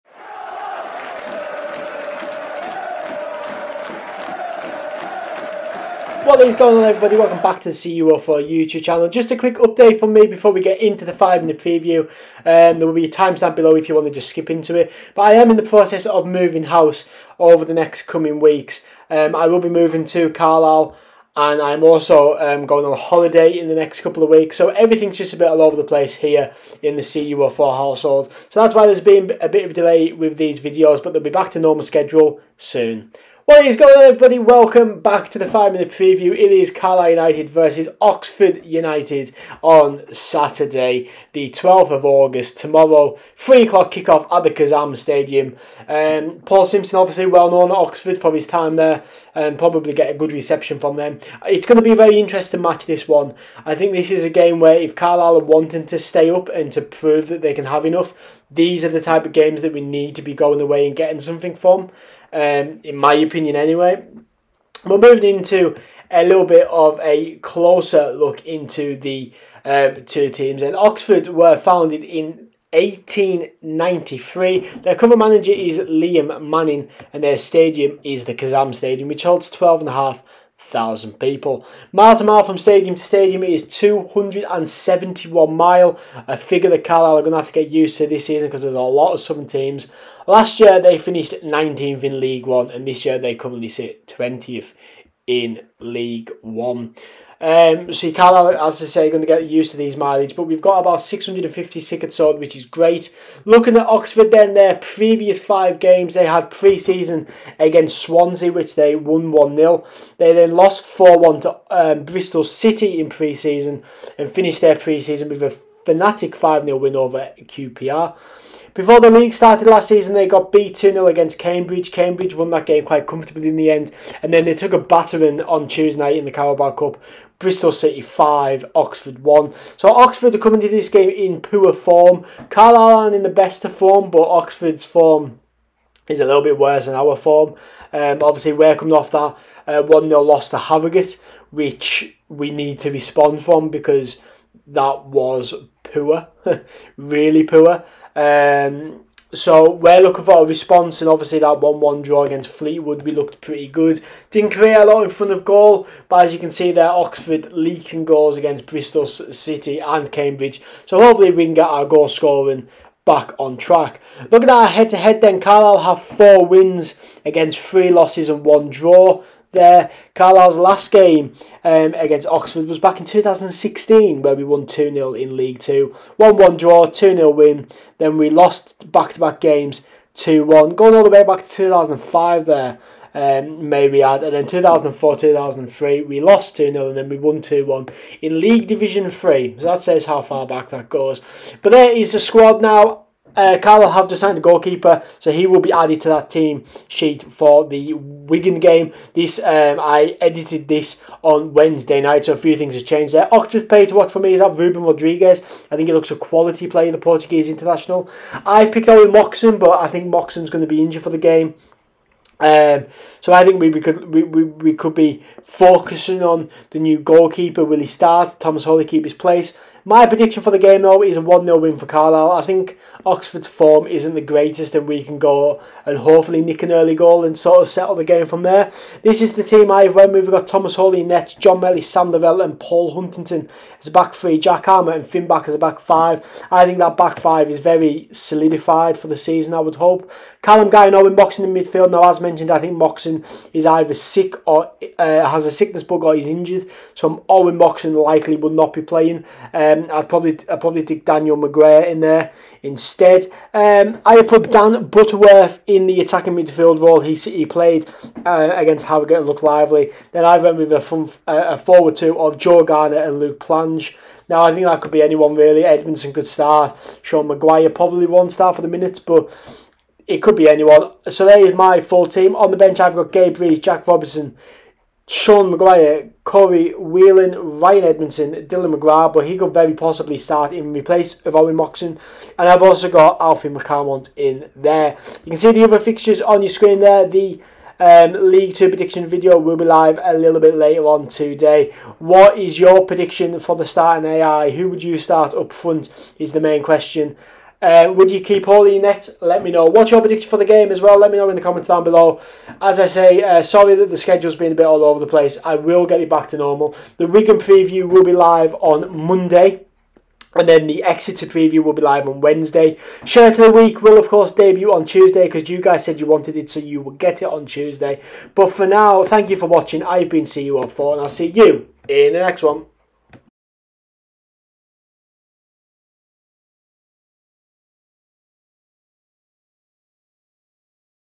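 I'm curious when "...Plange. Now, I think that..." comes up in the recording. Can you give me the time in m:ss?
4:23.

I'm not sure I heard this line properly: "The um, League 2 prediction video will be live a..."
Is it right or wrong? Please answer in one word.
right.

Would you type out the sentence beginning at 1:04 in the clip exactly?
We're moving into a little bit of a closer look into the um, two teams.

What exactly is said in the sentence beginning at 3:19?
This um, I edited this on Wednesday night, so a few things have changed there.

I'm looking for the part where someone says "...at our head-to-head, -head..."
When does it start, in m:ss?
2:44.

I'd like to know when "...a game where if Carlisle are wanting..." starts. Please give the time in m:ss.
0:54.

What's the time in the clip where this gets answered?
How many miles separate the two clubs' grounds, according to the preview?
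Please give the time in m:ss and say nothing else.
1:23.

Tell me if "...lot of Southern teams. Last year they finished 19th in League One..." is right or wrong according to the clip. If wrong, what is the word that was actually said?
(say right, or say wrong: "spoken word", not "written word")
right.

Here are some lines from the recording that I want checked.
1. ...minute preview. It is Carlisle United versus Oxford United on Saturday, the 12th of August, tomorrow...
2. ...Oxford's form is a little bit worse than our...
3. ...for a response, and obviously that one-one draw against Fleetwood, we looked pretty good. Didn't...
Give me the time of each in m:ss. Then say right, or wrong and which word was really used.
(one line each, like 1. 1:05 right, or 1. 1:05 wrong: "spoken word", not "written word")
1. 0:35 right
2. 2:14 right
3. 2:30 right.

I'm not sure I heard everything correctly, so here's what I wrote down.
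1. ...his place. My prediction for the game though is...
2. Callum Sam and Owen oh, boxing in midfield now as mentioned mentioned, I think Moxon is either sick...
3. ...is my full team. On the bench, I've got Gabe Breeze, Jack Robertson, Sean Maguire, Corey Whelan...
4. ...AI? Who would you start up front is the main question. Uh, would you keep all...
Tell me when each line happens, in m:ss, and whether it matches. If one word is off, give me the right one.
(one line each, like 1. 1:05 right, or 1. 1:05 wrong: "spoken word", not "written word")
1. 3:39 right
2. 4:00 wrong: "Guy", not "Sam"
3. 4:31 right
4. 4:54 right.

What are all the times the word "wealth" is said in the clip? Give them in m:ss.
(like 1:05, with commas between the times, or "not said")
not said.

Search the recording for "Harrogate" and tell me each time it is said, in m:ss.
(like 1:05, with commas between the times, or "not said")
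2:20, 4:18.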